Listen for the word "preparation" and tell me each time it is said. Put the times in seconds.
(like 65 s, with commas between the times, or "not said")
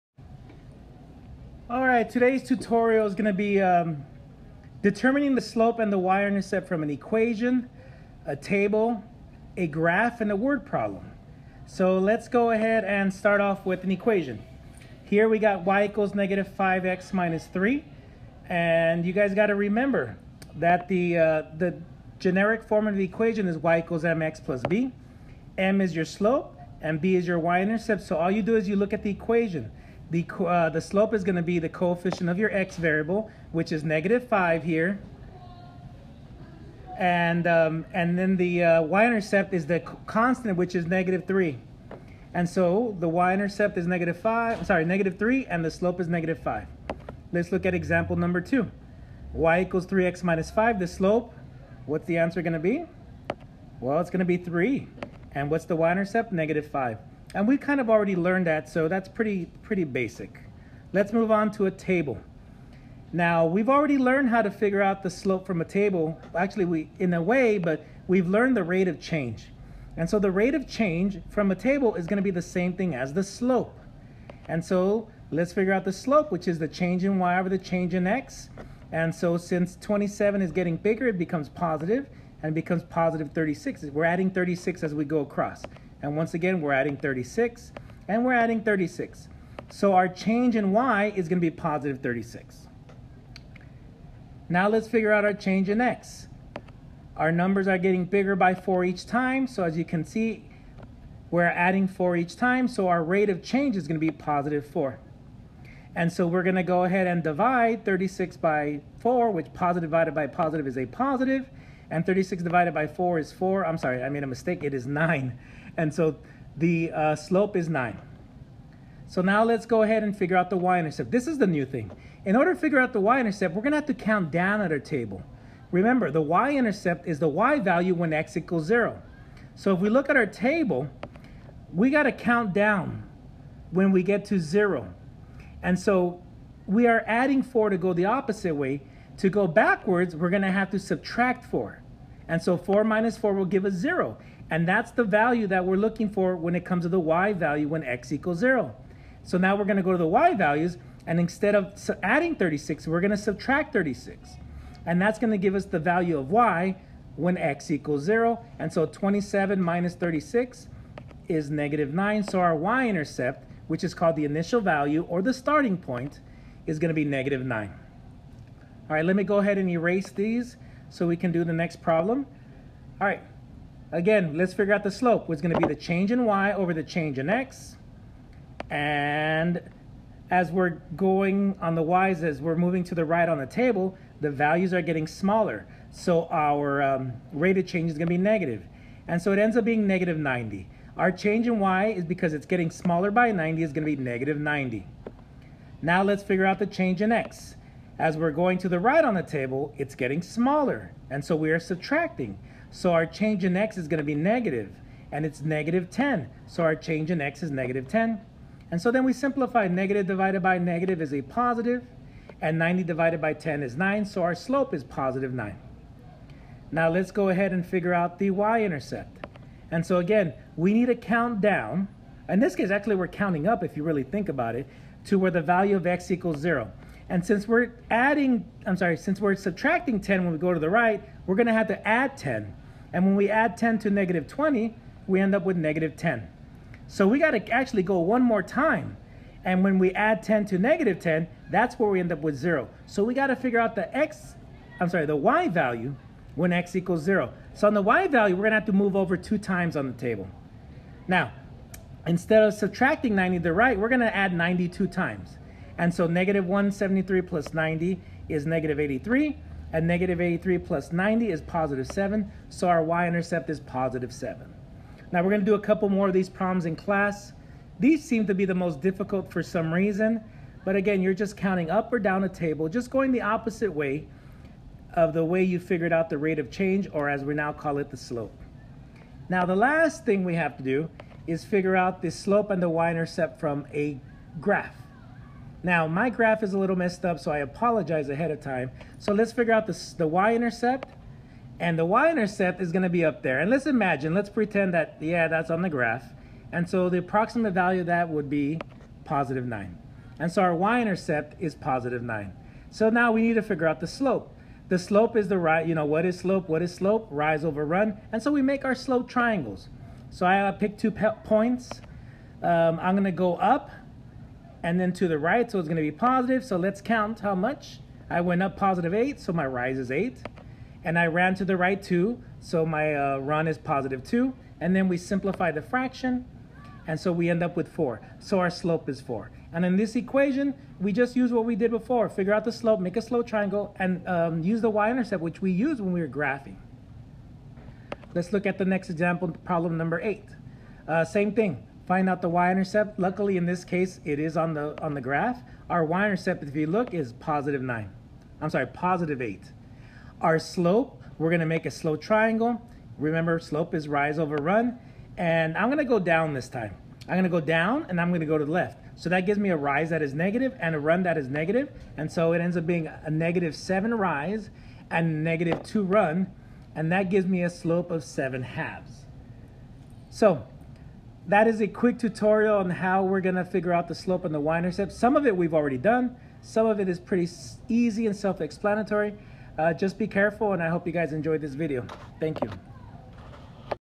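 not said.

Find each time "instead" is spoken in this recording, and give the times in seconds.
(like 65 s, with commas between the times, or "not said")
151 s, 252 s.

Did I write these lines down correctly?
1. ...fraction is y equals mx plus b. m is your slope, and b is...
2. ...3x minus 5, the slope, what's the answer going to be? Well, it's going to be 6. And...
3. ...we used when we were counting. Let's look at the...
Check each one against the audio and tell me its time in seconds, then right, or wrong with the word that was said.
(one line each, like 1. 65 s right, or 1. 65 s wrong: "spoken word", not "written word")
1. 23 s wrong: "equation", not "fraction"
2. 49 s wrong: "3", not "6"
3. 335 s wrong: "graphing", not "counting".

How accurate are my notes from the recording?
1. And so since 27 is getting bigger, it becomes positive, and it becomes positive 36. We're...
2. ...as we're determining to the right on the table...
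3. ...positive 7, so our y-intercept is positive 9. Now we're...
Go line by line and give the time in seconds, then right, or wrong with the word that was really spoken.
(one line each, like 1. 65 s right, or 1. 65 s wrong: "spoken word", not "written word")
1. 78 s right
2. 182 s wrong: "moving", not "determining"
3. 261 s wrong: "7", not "9".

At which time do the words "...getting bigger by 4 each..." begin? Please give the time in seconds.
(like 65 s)
97 s.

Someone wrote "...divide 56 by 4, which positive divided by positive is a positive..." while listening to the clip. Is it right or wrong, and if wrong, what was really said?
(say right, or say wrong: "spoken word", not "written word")
wrong: "36", not "56".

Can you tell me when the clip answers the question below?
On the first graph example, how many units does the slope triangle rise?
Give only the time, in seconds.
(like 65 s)
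318 s.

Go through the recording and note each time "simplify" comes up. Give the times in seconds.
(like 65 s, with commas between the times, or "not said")
209 s, 324 s.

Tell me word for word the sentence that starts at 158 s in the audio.
And so 27 minus 36 is negative 9.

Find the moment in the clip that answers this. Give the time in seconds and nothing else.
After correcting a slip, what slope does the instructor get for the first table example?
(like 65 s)
114 s.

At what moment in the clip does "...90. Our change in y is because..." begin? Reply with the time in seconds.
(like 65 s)
190 s.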